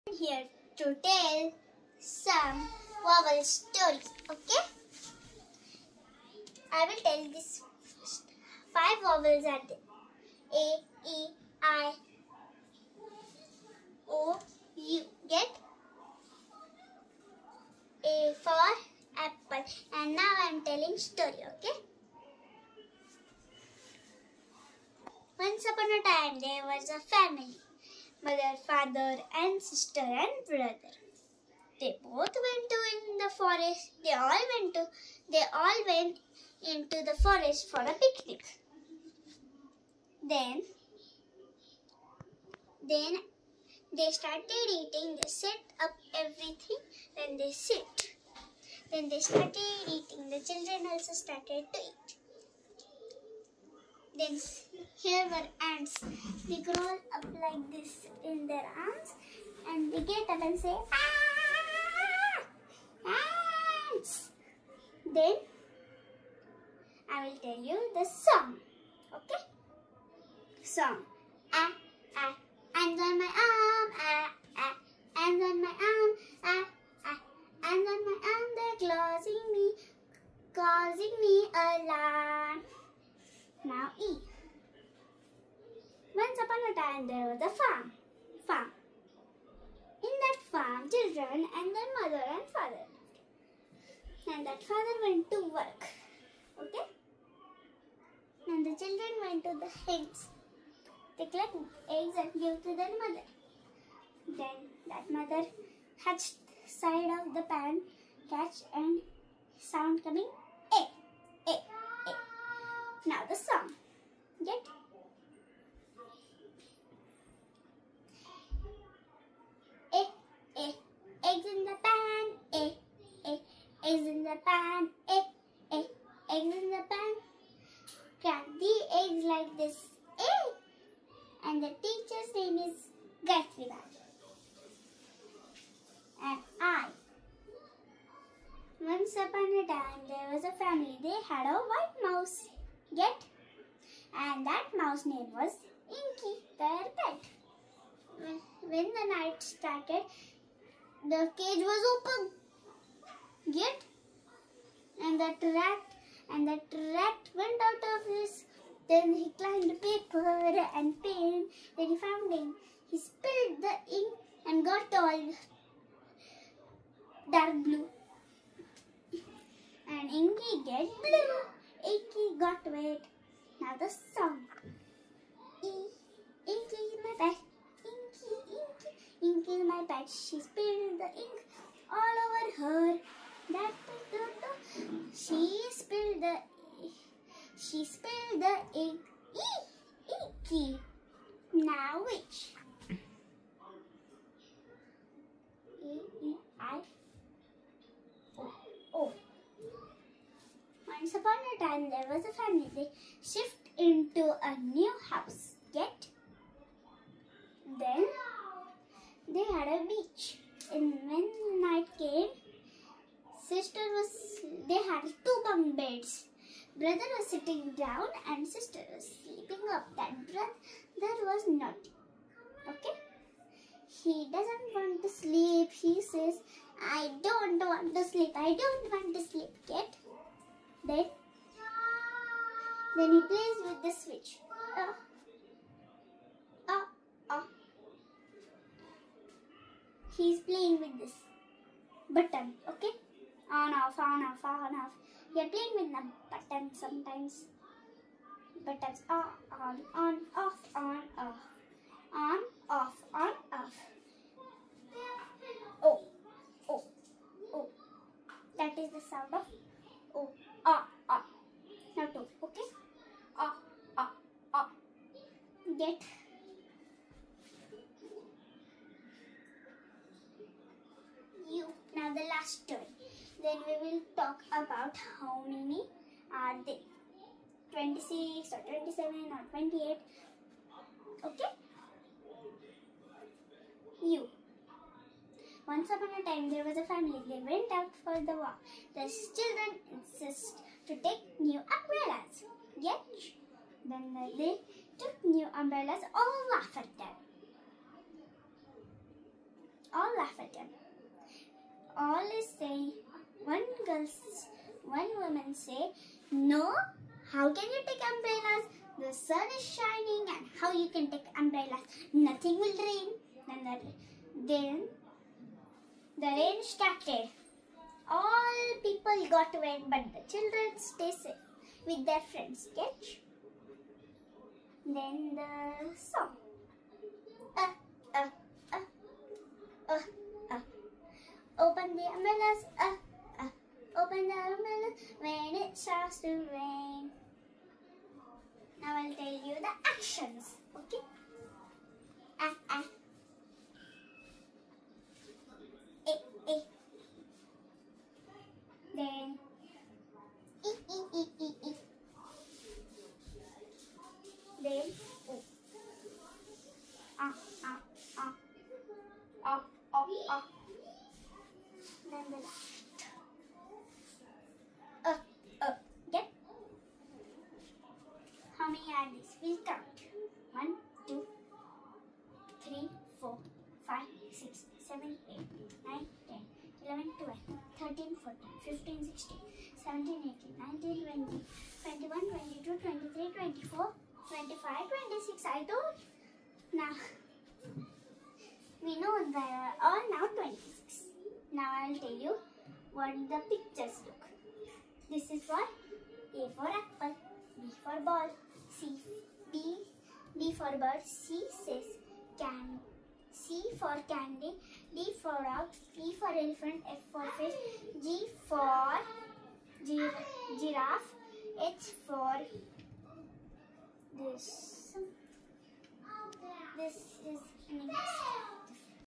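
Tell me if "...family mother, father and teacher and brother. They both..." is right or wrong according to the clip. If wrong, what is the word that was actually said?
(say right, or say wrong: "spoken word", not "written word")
wrong: "sister", not "teacher".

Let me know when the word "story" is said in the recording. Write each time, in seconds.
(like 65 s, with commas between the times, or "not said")
3 s, 20 s.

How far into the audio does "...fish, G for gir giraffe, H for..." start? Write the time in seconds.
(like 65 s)
407 s.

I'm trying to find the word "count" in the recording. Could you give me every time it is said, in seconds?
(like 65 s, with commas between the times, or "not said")
369 s.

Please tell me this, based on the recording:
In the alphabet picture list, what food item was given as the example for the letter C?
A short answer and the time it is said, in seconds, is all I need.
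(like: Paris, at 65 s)
candy, at 403 s.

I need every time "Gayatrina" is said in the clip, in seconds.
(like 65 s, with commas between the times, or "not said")
133 s.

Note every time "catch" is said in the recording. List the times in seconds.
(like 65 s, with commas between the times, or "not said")
108 s, 322 s.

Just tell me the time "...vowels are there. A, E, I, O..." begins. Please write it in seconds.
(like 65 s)
9 s.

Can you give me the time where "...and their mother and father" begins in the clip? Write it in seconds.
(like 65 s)
91 s.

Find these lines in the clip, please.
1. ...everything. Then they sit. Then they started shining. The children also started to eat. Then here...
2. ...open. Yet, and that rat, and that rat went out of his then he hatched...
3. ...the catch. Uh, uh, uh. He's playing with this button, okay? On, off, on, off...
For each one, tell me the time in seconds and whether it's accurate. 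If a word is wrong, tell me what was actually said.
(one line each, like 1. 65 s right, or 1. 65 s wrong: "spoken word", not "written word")
1. 46 s wrong: "eating", not "shining"
2. 151 s wrong: "climbed", not "hatched"
3. 233 s wrong: "switch", not "catch".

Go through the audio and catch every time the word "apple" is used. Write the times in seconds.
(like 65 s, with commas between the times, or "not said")
19 s, 396 s.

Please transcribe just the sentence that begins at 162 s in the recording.
He spilled the ink and got all dark blue.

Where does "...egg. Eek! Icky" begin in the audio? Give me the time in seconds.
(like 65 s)
188 s.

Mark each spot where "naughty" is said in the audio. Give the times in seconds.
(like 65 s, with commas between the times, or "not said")
221 s.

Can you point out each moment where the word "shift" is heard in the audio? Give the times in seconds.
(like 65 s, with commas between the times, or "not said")
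203 s.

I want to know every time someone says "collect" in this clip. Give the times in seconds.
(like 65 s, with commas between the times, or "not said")
101 s.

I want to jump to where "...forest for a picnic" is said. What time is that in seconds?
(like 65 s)
37 s.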